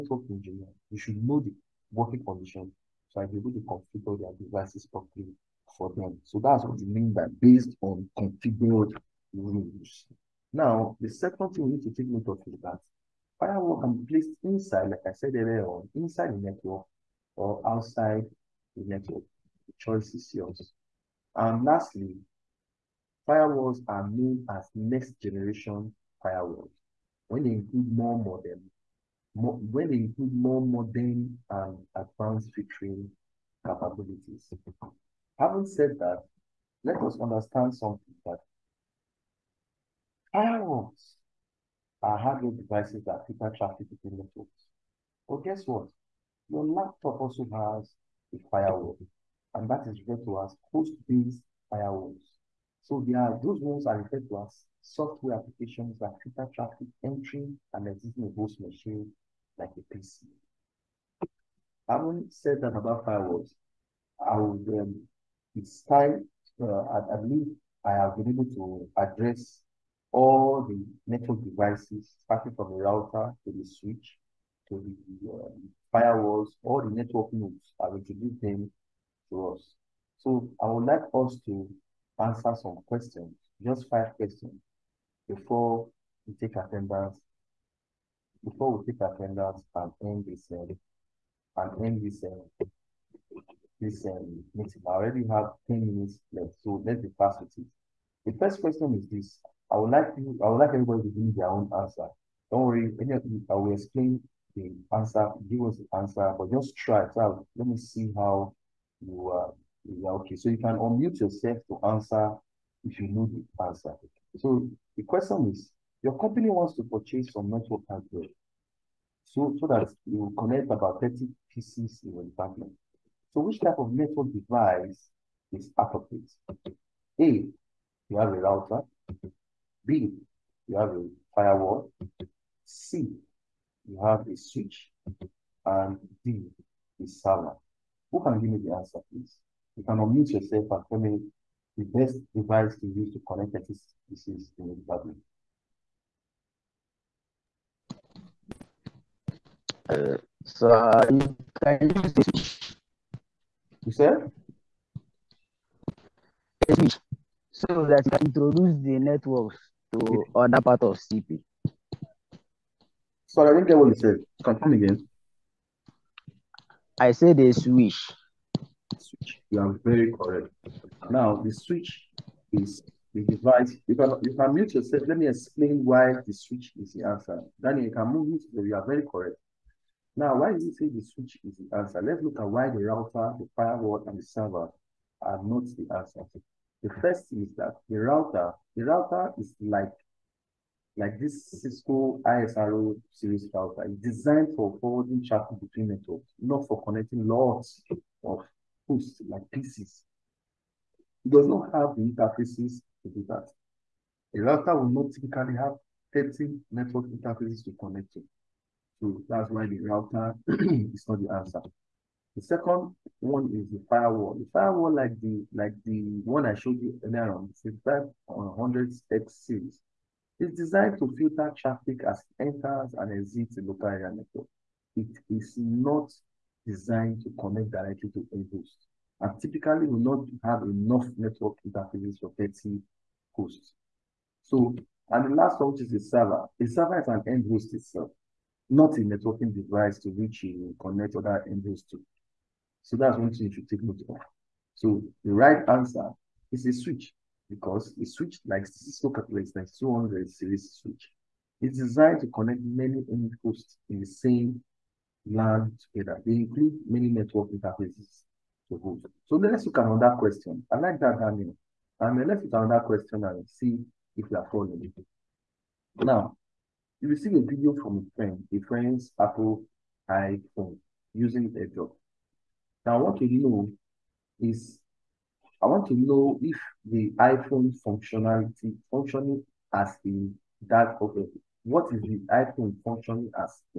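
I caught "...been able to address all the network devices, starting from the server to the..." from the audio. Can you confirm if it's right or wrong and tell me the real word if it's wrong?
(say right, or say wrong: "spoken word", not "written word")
wrong: "router", not "server".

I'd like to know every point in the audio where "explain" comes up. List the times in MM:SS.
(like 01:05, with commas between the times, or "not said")
01:43, 02:55.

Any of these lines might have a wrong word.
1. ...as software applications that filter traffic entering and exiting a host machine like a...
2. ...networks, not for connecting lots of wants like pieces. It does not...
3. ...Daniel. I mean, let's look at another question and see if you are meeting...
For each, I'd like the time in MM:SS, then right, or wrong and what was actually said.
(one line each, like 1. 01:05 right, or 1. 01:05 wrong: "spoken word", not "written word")
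1. 00:54 right
2. 03:15 wrong: "hosts", not "wants"
3. 04:21 wrong: "following", not "meeting".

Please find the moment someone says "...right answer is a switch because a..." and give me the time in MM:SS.
04:05.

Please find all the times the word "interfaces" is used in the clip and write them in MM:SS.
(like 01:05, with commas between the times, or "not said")
03:22, 03:27, 03:51, 04:17.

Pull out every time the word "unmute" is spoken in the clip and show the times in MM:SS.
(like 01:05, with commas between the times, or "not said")
01:50, 02:19.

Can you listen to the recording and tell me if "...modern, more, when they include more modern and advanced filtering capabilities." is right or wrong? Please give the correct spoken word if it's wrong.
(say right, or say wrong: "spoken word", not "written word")
right.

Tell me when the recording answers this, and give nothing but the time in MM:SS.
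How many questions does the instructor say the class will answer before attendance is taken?
01:23.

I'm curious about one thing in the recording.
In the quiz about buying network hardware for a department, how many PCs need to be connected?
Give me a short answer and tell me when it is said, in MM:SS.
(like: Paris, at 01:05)
30, at 02:01.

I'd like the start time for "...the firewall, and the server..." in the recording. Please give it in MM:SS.
03:03.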